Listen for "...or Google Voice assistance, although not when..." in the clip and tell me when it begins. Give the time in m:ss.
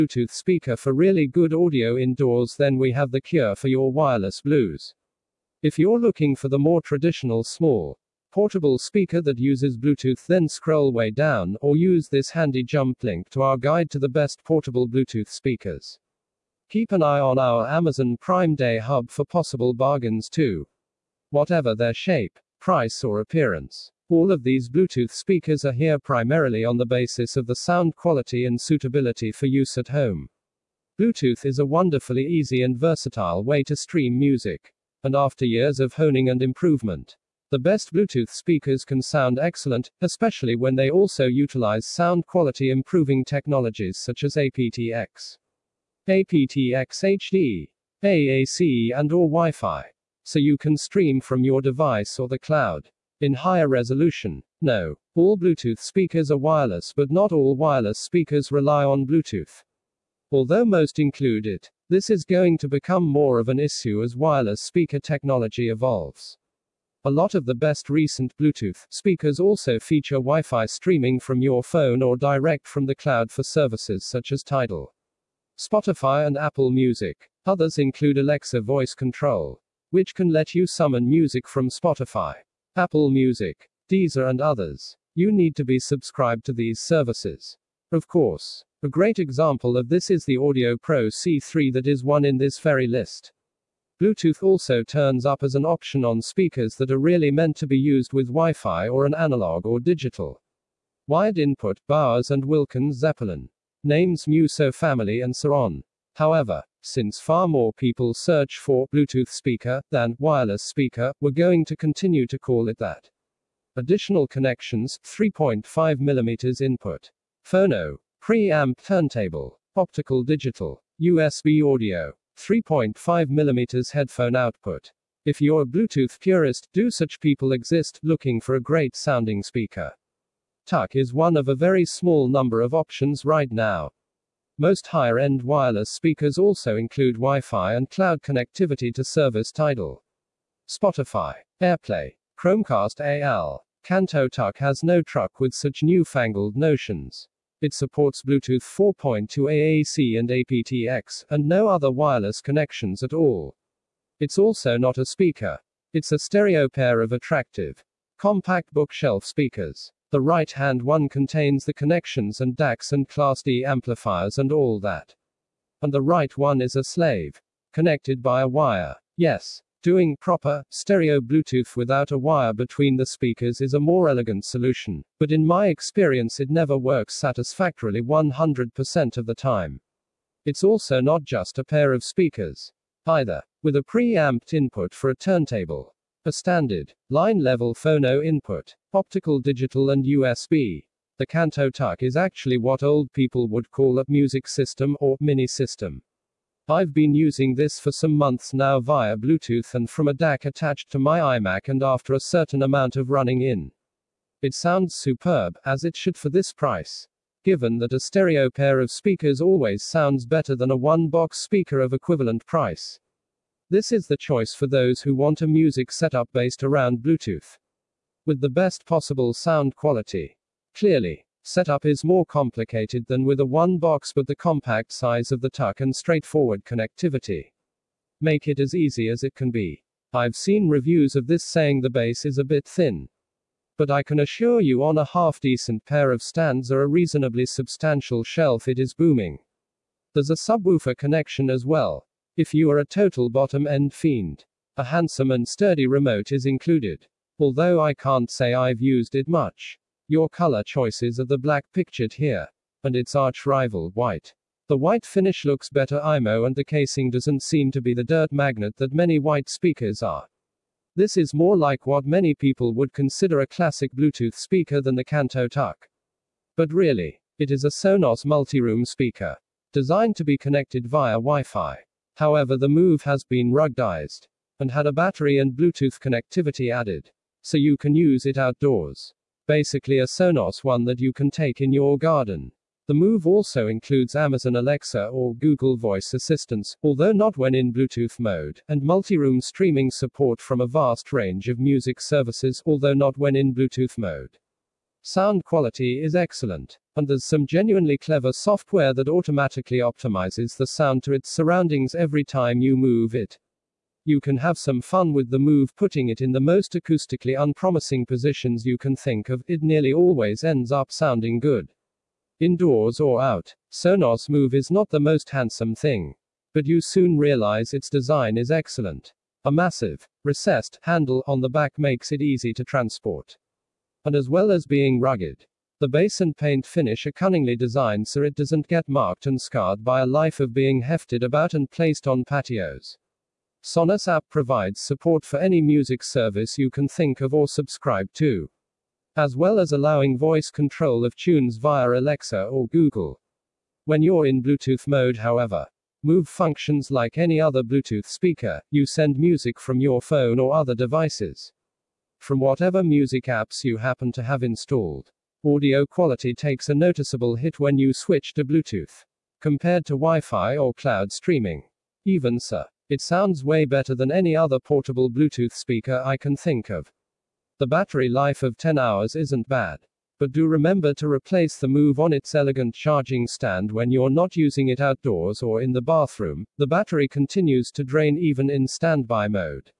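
4:45.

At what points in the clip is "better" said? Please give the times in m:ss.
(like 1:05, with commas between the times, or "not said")
3:30, 4:15, 6:03.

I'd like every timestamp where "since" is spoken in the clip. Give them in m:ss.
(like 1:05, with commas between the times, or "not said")
1:46.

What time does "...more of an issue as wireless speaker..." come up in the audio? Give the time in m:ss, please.
1:03.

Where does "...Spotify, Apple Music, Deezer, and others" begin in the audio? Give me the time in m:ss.
1:21.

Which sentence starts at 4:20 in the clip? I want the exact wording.
This is more like what many people would consider a classic Bluetooth speaker than the Kanto TUK.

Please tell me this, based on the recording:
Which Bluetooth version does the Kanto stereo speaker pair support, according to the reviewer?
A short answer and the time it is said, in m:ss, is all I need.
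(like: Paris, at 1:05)
4.2, at 2:28.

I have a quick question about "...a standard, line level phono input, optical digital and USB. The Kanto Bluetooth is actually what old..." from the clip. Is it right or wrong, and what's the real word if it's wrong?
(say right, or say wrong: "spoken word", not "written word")
wrong: "TUK", not "Bluetooth".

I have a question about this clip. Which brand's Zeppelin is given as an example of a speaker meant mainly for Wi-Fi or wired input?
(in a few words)
Bowers and Wilkins.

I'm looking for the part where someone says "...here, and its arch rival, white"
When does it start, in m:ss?
4:12.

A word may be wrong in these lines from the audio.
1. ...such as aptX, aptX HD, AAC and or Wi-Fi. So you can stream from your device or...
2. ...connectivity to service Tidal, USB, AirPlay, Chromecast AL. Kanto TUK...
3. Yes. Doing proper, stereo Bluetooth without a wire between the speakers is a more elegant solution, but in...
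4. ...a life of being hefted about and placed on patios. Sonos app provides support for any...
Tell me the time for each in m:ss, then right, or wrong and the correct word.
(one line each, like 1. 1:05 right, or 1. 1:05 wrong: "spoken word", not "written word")
1. 0:43 right
2. 2:18 wrong: "Spotify", not "USB"
3. 2:49 right
4. 5:30 right.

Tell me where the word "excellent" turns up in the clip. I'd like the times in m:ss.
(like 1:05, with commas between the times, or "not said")
0:39, 4:56, 5:18.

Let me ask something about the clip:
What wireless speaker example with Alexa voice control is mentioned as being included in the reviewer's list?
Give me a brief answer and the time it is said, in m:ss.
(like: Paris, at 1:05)
Audio Pro C3, at 1:30.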